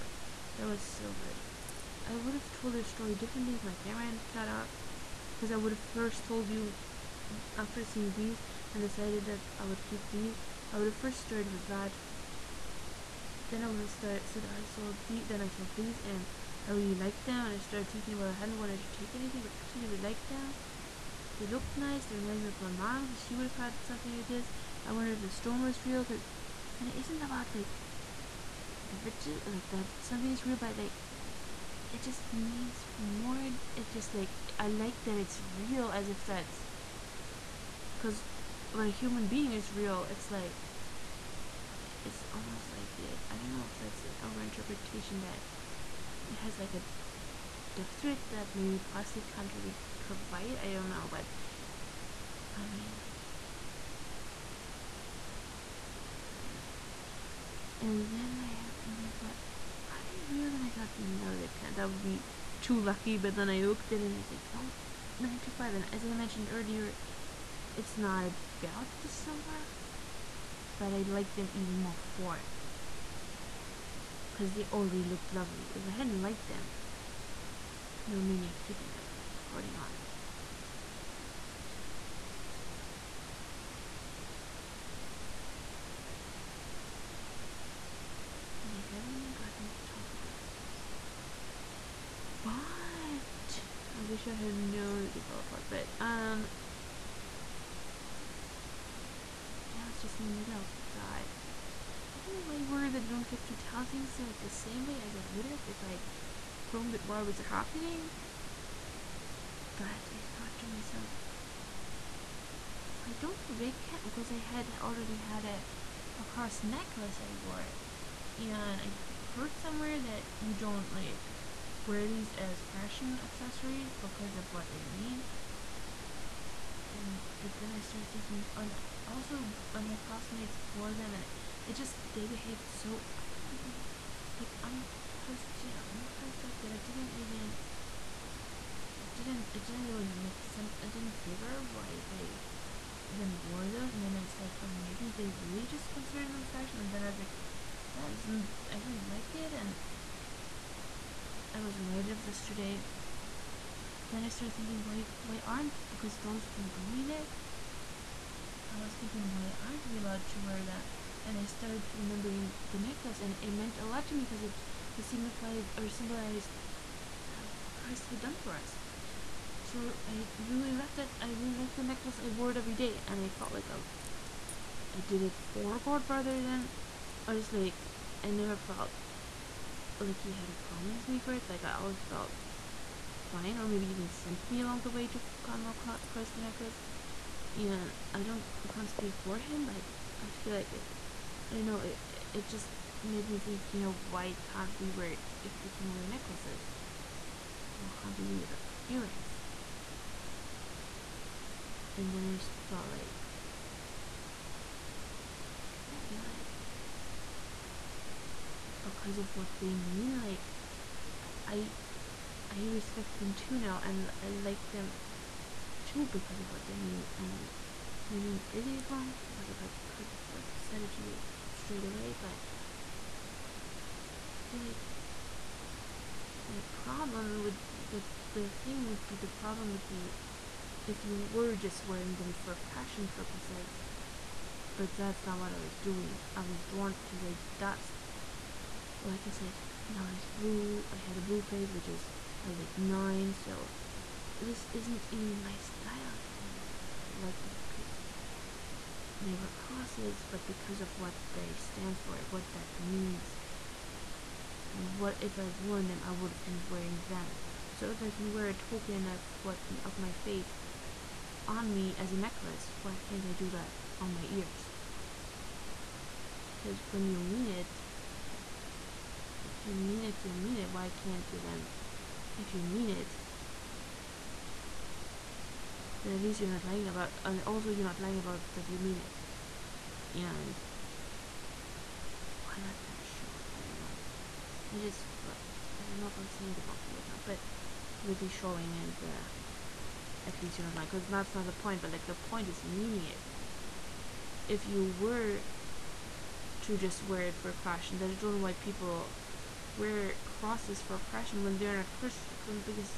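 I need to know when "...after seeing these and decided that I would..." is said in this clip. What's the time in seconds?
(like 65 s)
7 s.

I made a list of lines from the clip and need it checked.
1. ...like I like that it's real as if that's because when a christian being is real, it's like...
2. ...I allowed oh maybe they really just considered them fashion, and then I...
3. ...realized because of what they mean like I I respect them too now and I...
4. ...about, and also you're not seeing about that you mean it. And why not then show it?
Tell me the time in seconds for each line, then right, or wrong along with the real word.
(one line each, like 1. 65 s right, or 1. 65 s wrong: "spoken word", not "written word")
1. 34 s wrong: "human", not "christian"
2. 144 s wrong: "started", not "allowed"
3. 206 s right
4. 276 s wrong: "lying", not "seeing".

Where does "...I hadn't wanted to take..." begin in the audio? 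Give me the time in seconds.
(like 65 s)
18 s.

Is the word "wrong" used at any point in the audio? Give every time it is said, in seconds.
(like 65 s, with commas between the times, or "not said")
218 s, 286 s.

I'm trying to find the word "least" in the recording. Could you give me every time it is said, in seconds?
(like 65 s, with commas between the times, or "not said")
276 s, 290 s.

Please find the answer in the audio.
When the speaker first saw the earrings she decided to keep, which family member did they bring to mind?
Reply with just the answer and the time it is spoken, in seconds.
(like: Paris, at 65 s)
Mom, at 22 s.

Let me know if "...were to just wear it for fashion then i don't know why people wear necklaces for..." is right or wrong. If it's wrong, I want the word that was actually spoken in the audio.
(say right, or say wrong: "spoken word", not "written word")
wrong: "crosses", not "necklaces".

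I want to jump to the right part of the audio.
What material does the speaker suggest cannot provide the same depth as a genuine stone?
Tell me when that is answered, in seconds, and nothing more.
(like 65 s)
48 s.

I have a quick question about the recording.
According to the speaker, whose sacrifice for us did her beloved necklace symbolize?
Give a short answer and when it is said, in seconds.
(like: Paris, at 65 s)
Christ, at 167 s.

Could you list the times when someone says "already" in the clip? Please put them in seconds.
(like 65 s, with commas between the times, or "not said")
74 s, 114 s.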